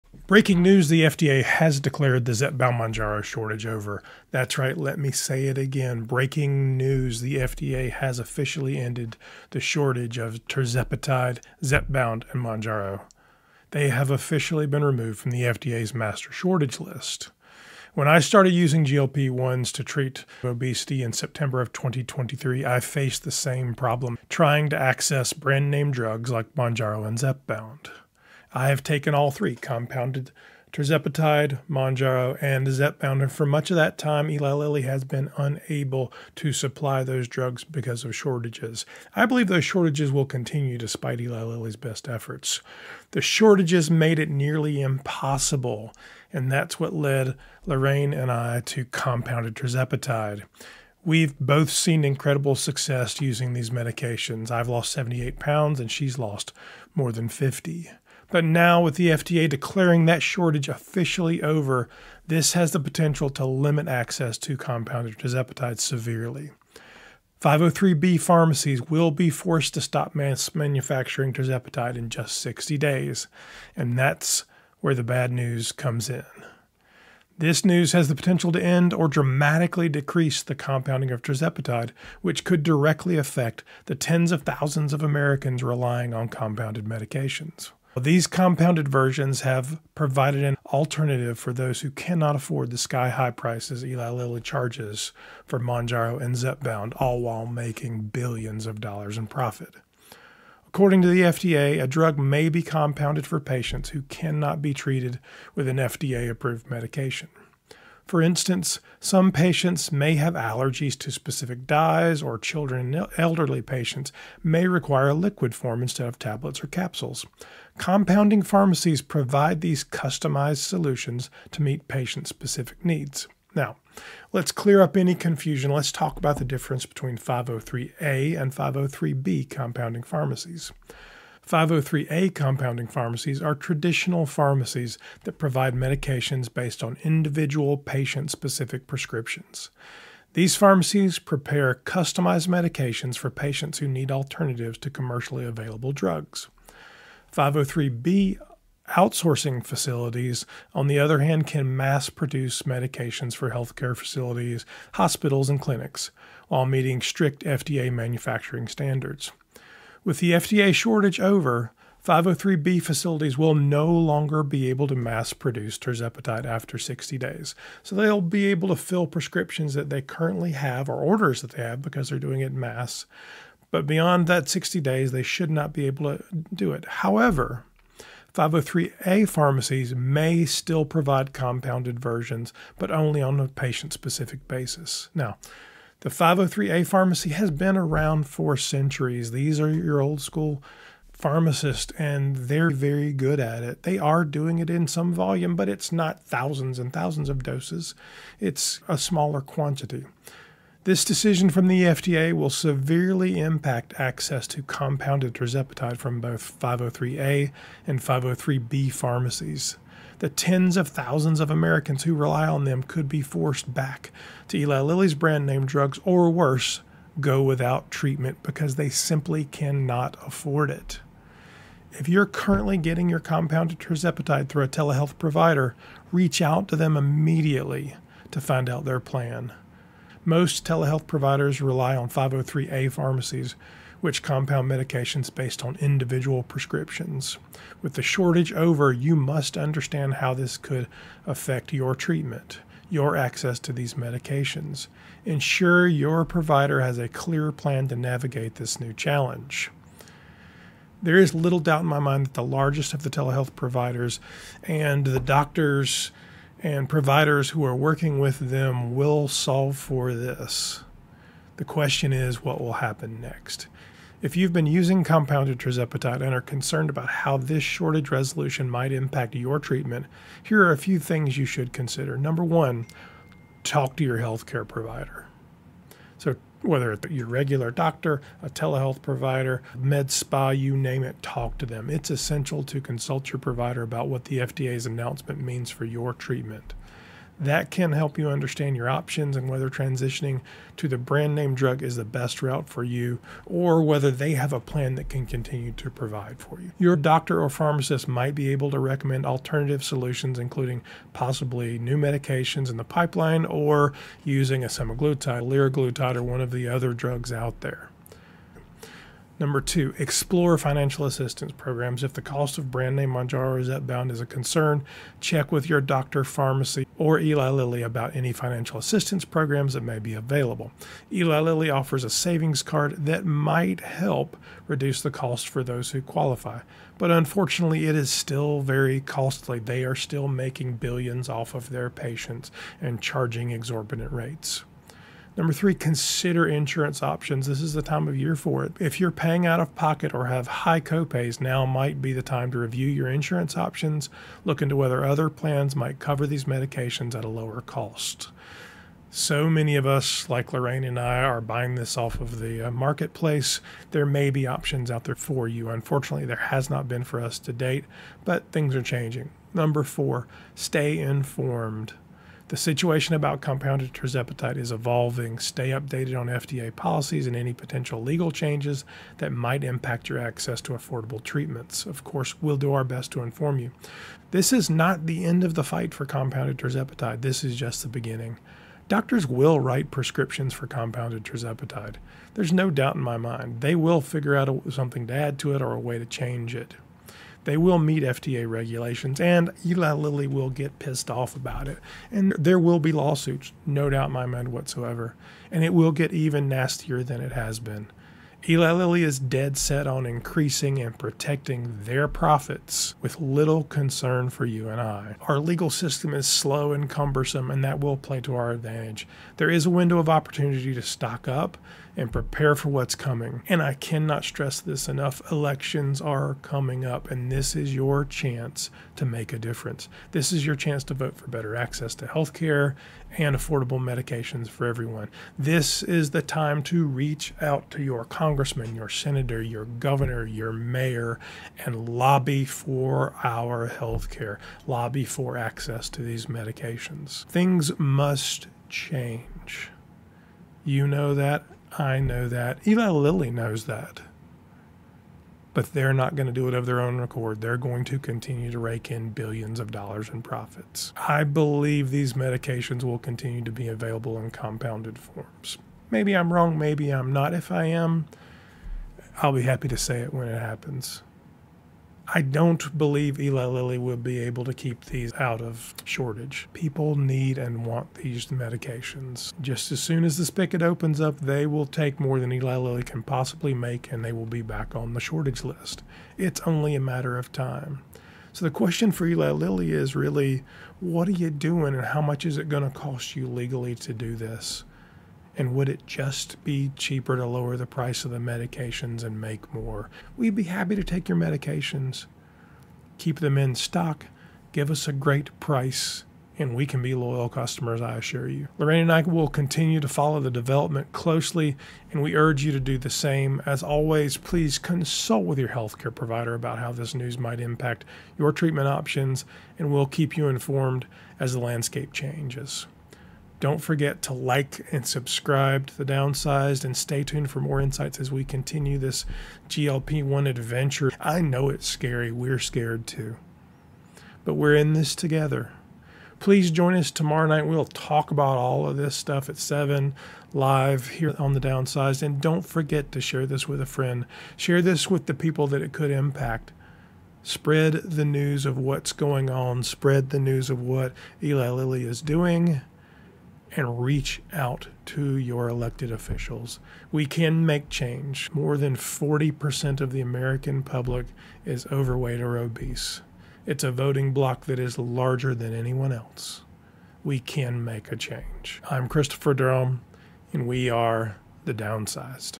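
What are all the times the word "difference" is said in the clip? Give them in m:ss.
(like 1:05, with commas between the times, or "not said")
2:06, 6:59.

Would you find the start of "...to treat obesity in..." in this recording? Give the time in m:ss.
0:19.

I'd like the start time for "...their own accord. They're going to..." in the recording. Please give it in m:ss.
7:26.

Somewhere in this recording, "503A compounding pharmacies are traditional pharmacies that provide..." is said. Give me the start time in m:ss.
2:11.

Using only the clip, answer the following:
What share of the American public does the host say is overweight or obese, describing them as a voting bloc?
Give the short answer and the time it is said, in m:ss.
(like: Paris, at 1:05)
More than 40%, at 9:08.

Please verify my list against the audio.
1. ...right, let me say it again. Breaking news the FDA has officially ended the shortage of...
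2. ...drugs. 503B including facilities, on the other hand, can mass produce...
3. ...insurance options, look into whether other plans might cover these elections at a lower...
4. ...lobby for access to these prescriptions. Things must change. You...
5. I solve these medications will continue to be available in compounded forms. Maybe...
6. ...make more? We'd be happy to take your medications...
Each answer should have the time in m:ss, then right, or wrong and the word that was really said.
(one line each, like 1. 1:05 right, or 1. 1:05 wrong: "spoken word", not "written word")
1. 0:04 right
2. 2:25 wrong: "outsourcing", not "including"
3. 5:43 wrong: "medications", not "elections"
4. 7:14 wrong: "medications", not "prescriptions"
5. 7:30 wrong: "believe", not "solve"
6. 8:09 right.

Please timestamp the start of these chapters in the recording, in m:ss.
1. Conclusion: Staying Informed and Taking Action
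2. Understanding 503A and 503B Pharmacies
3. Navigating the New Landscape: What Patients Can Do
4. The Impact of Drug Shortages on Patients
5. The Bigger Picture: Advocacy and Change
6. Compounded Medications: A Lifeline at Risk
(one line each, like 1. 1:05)
1. 8:18
2. 2:03
3. 3:41
4. 0:17
5. 6:49
6. 0:58.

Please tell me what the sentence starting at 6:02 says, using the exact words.
The situation about compounded tirzepatide is evolving.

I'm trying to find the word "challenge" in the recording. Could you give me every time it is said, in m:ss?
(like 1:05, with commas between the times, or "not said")
4:08.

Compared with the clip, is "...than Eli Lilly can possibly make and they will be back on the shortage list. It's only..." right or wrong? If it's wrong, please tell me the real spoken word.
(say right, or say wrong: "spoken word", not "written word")
right.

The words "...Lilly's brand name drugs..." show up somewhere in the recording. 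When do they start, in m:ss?
3:34.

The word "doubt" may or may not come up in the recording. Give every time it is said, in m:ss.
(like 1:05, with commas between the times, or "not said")
4:11, 6:22, 6:33.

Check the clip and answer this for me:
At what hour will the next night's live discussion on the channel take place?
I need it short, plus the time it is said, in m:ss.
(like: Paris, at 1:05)
7, at 8:49.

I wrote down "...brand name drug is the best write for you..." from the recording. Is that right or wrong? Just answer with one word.
wrong.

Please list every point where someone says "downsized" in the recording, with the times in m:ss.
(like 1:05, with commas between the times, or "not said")
8:35, 8:51, 9:21.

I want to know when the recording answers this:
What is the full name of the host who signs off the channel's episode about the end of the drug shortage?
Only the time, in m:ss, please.
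9:18.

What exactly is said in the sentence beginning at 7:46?
People need and want these medications.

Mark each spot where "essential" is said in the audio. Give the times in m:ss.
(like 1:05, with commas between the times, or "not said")
4:42.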